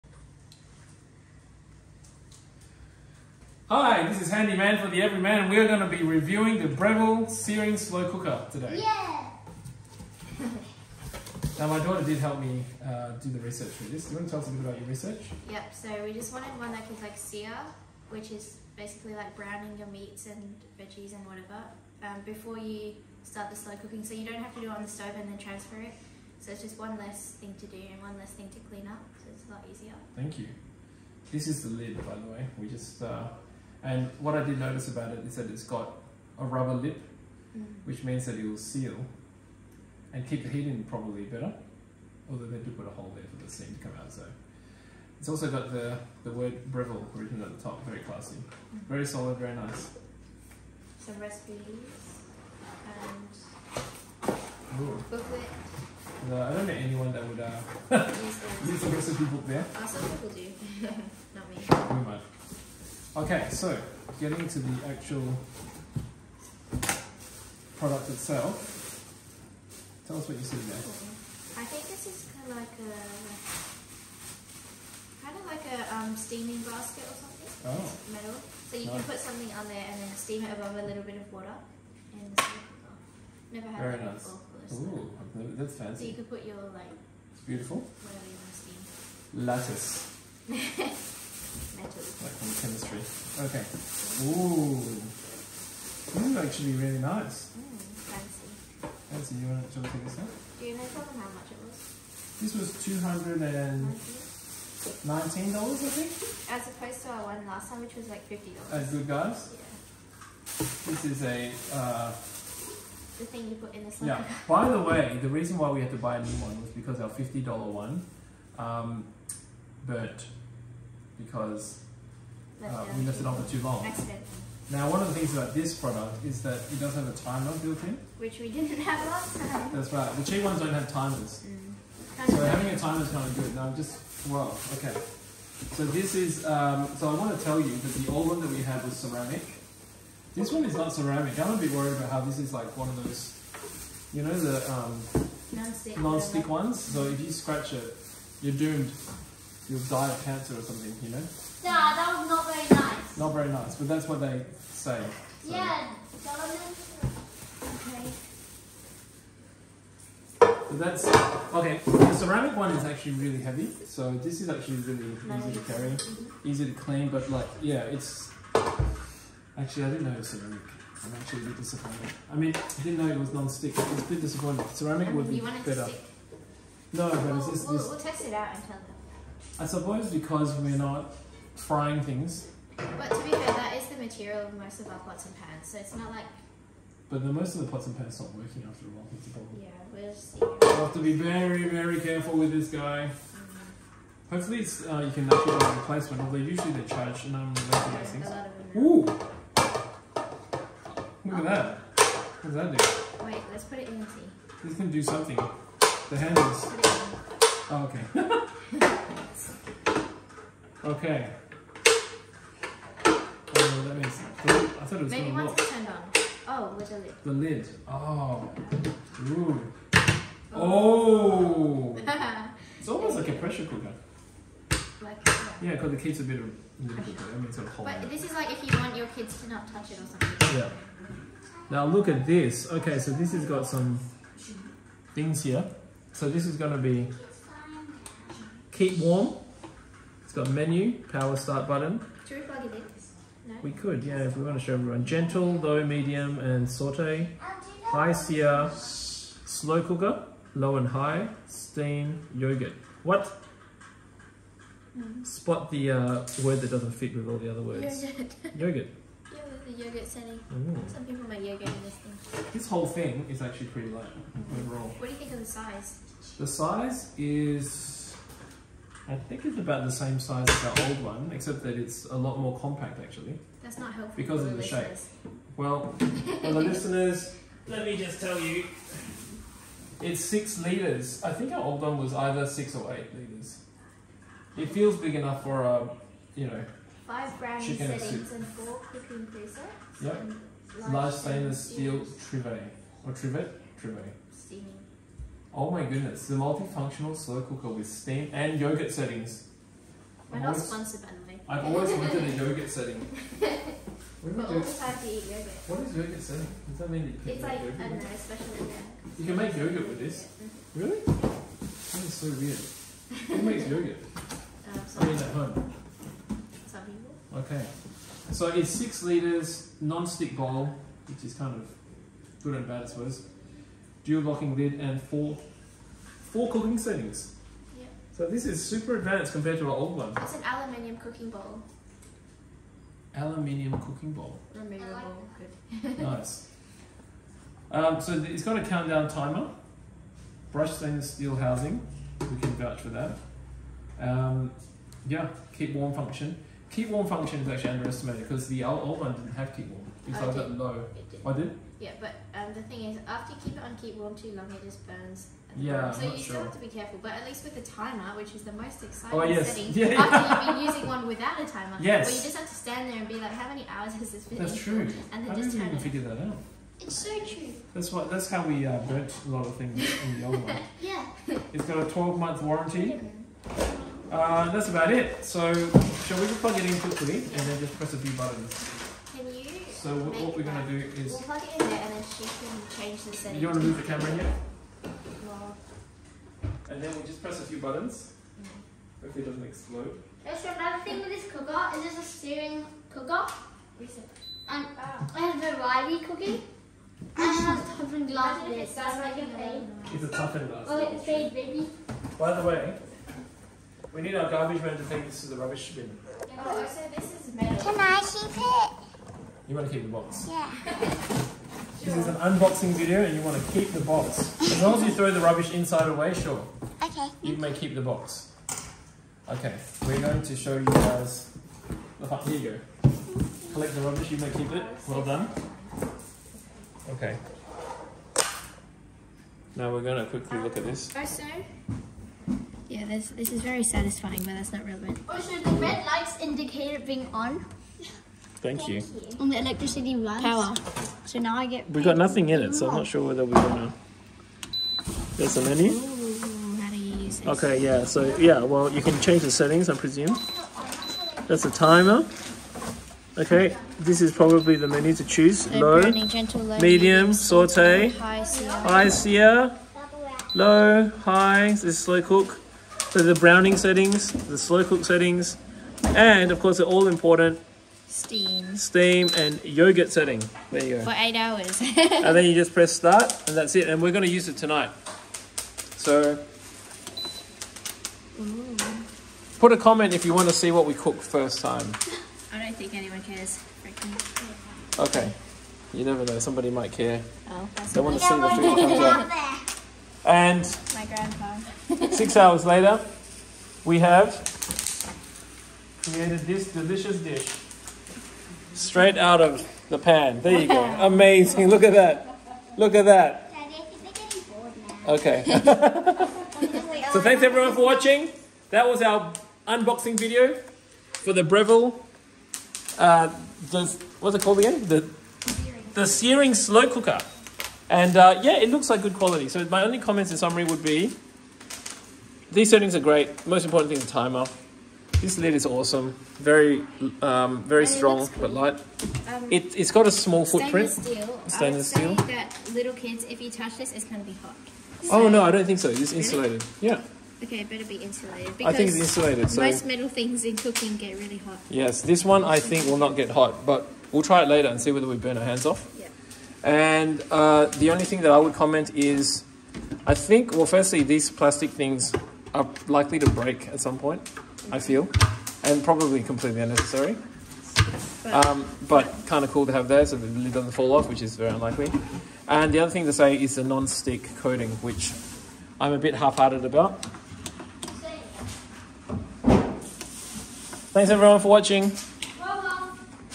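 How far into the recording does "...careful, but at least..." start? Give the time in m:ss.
5:56.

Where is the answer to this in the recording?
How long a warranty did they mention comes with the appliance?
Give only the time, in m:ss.
6:11.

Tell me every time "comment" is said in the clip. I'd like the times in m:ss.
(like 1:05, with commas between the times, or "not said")
7:59, 8:39, 9:08.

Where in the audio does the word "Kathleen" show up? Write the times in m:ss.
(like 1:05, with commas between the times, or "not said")
not said.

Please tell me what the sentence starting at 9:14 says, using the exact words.
I feel, and probably completely unnecessary.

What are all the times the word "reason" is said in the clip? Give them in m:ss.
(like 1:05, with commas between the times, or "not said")
1:55.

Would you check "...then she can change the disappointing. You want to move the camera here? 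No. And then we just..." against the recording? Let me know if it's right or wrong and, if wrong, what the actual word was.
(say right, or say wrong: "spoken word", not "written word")
wrong: "setting", not "disappointing".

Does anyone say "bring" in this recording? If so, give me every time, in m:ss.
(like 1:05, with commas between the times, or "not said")
not said.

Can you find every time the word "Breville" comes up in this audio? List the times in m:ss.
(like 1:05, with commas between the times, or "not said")
0:06, 0:46, 8:31.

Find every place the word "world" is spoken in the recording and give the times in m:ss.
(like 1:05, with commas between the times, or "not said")
not said.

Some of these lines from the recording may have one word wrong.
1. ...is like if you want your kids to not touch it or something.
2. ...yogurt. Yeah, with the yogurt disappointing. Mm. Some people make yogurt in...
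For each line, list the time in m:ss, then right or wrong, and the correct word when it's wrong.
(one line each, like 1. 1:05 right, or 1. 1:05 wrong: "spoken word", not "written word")
1. 3:48 right
2. 4:18 wrong: "setting", not "disappointing".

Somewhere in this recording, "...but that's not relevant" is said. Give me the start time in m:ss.
7:14.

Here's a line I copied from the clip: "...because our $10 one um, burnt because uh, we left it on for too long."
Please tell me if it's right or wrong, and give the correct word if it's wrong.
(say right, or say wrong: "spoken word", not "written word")
wrong: "50", not "10".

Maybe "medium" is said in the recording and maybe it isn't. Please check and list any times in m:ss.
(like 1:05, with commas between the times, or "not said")
4:05, 7:36.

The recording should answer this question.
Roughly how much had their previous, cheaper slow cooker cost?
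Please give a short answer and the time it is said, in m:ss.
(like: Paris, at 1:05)
$50, at 1:48.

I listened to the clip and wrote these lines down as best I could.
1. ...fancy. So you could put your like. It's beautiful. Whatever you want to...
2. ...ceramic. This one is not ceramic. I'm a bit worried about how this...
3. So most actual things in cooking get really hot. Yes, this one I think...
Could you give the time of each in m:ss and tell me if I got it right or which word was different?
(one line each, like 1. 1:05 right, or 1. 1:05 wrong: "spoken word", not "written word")
1. 1:25 right
2. 2:18 right
3. 8:59 wrong: "metal", not "actual".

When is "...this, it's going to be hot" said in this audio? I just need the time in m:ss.
8:53.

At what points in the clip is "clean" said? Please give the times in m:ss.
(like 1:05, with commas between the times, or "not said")
0:28, 2:46.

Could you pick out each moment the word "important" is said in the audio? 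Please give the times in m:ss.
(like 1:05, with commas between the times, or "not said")
7:46, 8:43.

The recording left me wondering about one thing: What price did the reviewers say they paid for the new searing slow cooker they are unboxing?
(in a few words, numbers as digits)
$219.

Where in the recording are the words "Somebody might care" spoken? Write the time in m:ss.
8:06.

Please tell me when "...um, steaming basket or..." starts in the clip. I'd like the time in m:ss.
1:15.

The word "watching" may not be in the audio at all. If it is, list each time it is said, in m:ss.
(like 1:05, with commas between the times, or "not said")
8:27, 9:31.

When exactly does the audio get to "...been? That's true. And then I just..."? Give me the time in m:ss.
6:04.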